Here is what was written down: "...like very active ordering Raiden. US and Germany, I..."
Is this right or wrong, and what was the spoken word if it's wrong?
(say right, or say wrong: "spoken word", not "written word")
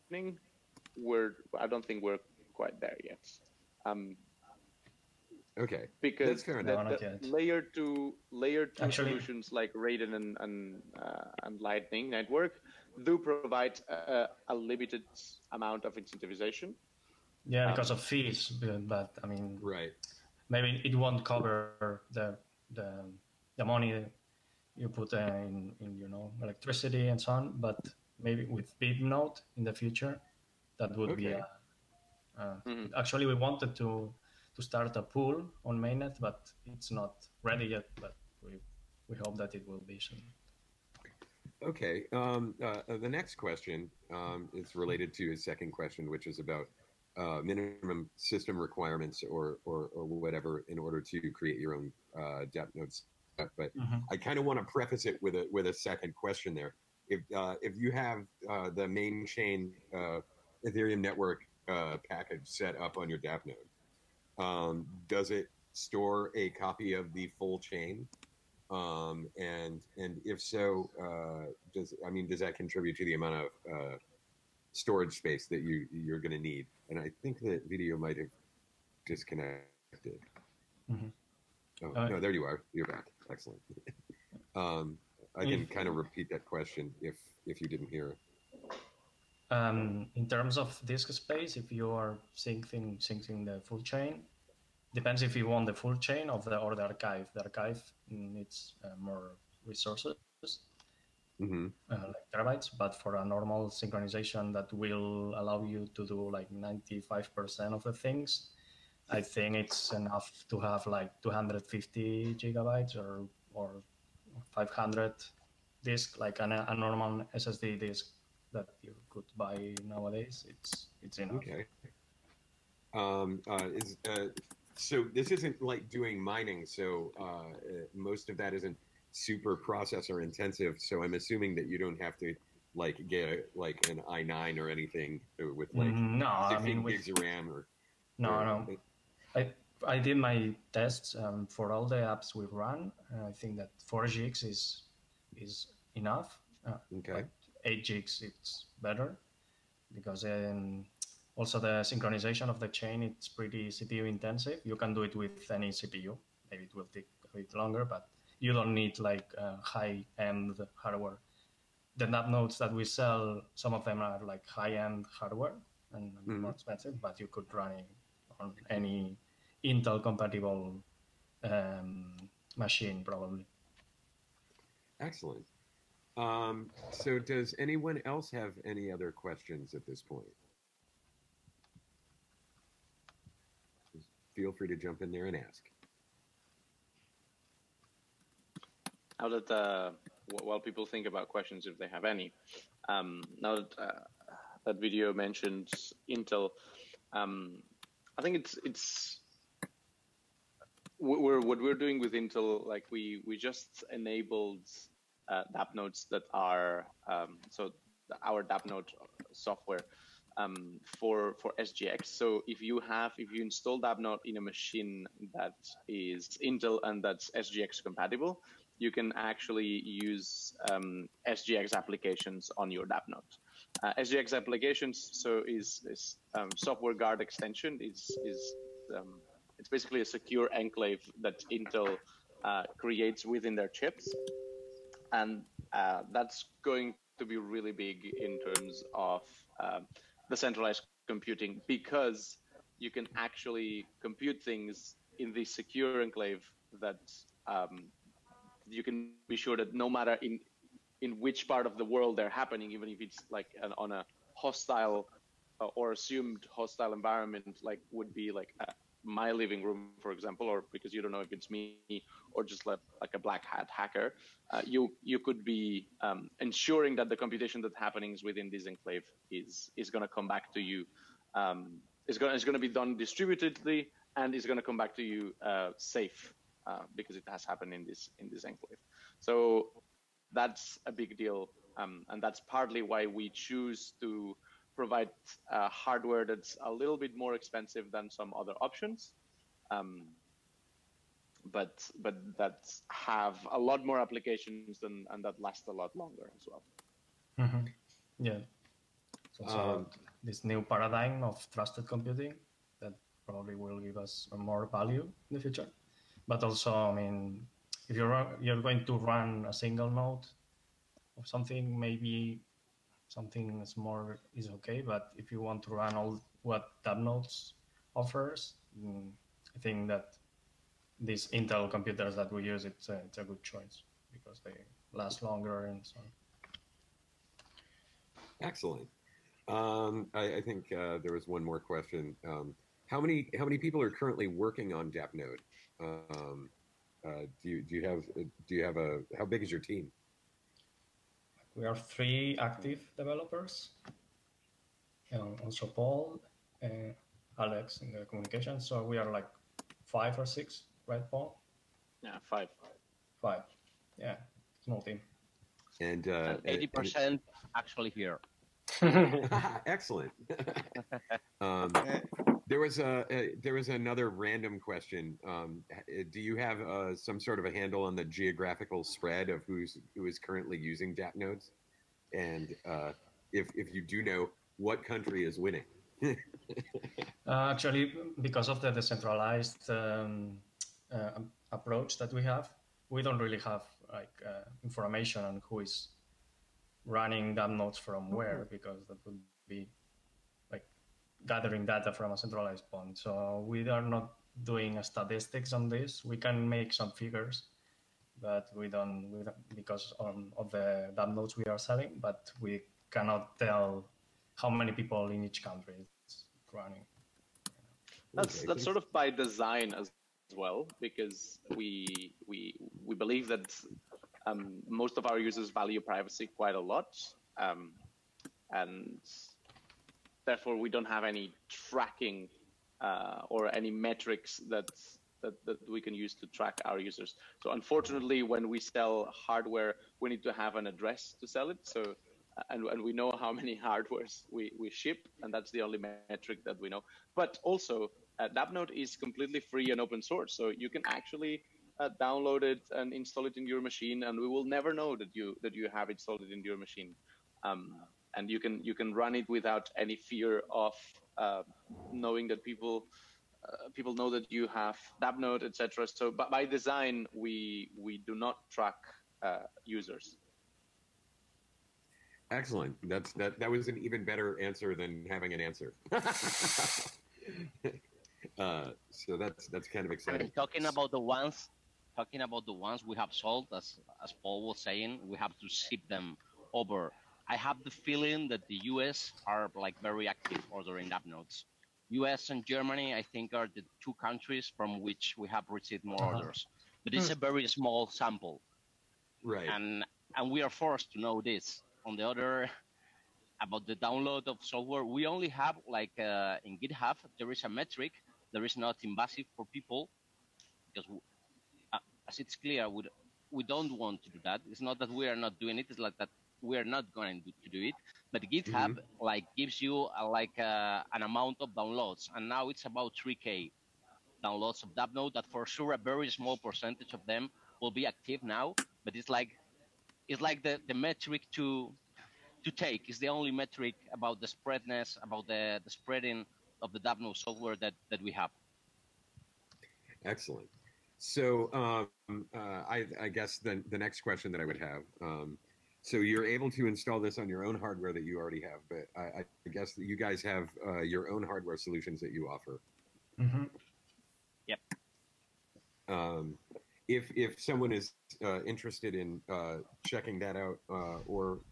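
wrong: "DAppNodes", not "Raiden".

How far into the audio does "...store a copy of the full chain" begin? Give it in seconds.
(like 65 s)
65 s.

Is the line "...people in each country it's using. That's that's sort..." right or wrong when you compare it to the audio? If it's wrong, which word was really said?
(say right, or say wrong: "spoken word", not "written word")
wrong: "running", not "using".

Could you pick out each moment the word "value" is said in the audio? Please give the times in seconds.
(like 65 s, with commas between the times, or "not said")
304 s, 415 s.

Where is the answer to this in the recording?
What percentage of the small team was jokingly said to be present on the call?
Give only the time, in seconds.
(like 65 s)
356 s.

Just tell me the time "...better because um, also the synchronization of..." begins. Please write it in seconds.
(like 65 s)
148 s.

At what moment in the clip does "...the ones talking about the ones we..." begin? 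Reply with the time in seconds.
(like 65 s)
470 s.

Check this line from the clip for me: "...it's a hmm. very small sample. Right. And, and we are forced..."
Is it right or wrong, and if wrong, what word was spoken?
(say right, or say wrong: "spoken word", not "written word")
right.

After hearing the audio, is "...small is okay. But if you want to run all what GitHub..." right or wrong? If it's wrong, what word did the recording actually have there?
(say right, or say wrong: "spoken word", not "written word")
wrong: "DAppNodes", not "GitHub".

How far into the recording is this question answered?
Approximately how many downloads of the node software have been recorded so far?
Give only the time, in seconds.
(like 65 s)
513 s.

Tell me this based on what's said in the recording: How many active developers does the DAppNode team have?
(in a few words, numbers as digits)
3.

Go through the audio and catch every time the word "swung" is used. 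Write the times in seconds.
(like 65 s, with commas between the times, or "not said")
not said.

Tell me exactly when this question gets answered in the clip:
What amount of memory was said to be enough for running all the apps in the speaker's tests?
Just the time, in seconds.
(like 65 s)
143 s.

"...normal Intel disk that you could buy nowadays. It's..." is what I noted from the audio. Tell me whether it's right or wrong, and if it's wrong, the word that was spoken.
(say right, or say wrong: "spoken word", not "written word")
wrong: "SSD", not "Intel".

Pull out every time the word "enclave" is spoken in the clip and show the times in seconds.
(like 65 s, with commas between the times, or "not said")
230 s, 246 s, 268 s, 278 s.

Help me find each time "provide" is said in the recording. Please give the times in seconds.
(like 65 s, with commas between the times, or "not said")
13 s, 284 s.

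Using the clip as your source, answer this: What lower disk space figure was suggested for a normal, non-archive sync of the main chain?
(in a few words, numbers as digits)
250 gigabytes.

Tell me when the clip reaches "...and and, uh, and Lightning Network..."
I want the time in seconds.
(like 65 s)
10 s.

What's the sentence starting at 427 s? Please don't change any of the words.
So unfortunately, when we sell hardware, we need to have an address to sell it.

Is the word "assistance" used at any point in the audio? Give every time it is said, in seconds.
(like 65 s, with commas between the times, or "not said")
not said.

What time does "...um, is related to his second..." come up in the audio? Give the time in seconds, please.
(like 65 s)
44 s.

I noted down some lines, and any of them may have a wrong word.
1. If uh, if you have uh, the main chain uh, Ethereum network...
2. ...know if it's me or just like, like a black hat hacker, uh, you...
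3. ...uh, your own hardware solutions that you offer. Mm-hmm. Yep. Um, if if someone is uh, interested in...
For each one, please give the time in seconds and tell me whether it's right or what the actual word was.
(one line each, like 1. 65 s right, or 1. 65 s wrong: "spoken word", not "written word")
1. 57 s right
2. 261 s right
3. 540 s right.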